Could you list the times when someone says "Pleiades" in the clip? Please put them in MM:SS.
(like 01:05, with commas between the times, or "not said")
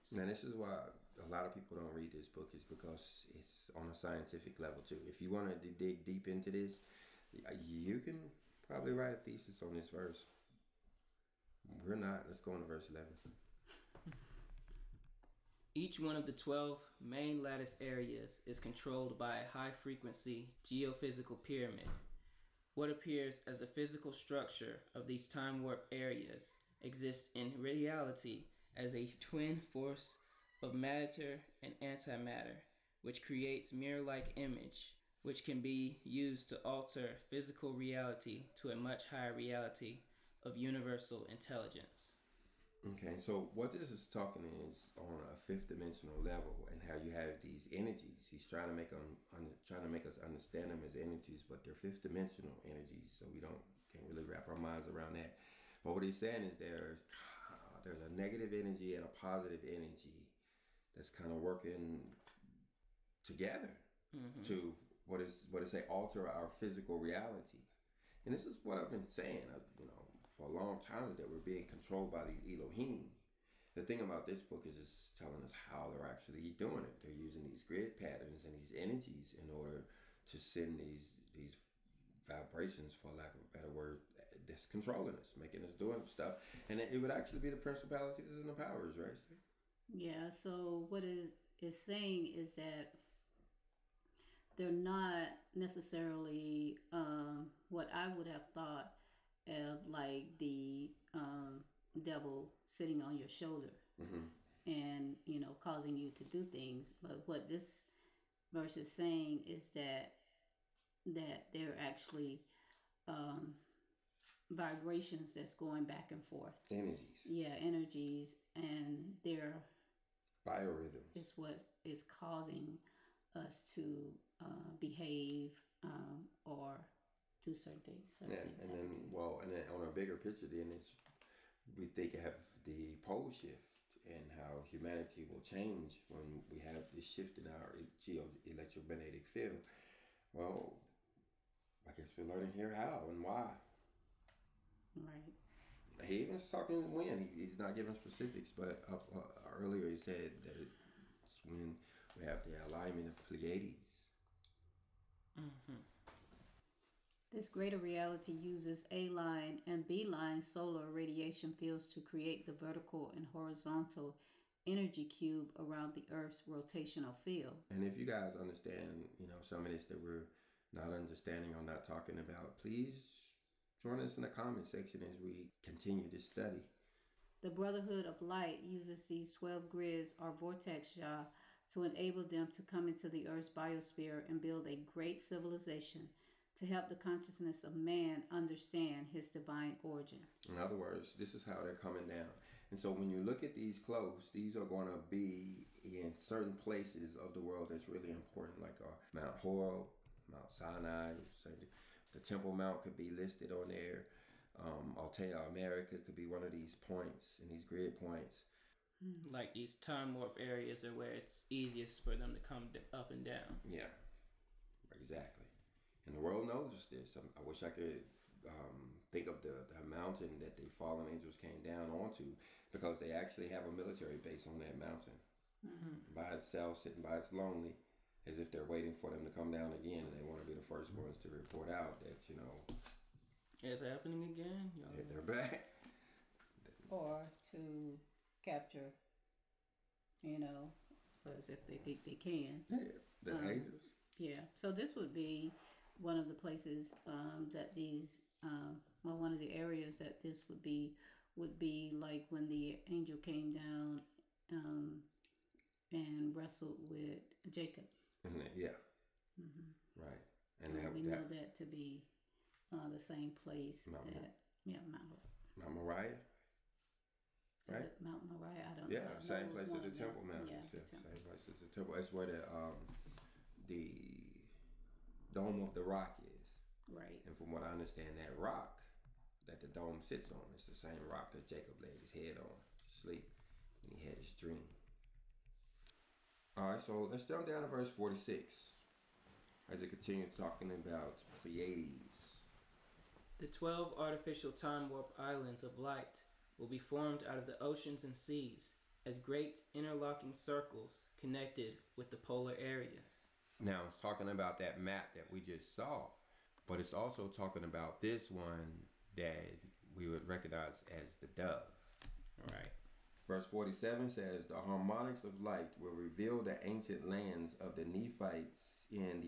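02:33, 04:51.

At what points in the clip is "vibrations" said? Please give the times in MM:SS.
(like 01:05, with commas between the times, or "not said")
01:22, 01:54.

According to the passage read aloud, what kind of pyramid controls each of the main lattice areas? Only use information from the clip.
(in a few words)
high frequency geophysical pyramid.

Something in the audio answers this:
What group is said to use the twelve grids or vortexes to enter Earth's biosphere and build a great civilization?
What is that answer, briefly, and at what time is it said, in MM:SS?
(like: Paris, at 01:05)
The Brotherhood of Light, at 02:57.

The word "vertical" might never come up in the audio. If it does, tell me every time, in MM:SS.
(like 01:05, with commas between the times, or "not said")
02:42.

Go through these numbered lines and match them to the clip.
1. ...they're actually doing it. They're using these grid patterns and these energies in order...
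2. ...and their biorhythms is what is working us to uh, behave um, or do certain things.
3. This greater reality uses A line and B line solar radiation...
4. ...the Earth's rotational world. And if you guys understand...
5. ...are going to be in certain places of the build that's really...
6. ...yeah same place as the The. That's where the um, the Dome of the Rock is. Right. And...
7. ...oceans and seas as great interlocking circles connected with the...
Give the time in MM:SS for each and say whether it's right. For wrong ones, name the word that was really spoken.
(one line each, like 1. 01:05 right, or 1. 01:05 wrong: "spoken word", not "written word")
1. 01:15 right
2. 01:58 wrong: "causing", not "working"
3. 02:37 right
4. 02:45 wrong: "field", not "world"
5. 03:14 wrong: "world", not "build"
6. 04:30 wrong: "Temple", not "The"
7. 04:57 right.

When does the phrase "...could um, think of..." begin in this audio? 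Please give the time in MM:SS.
03:37.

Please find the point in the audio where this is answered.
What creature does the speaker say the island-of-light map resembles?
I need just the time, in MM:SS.
05:11.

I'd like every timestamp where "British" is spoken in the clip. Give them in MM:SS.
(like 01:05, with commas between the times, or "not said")
not said.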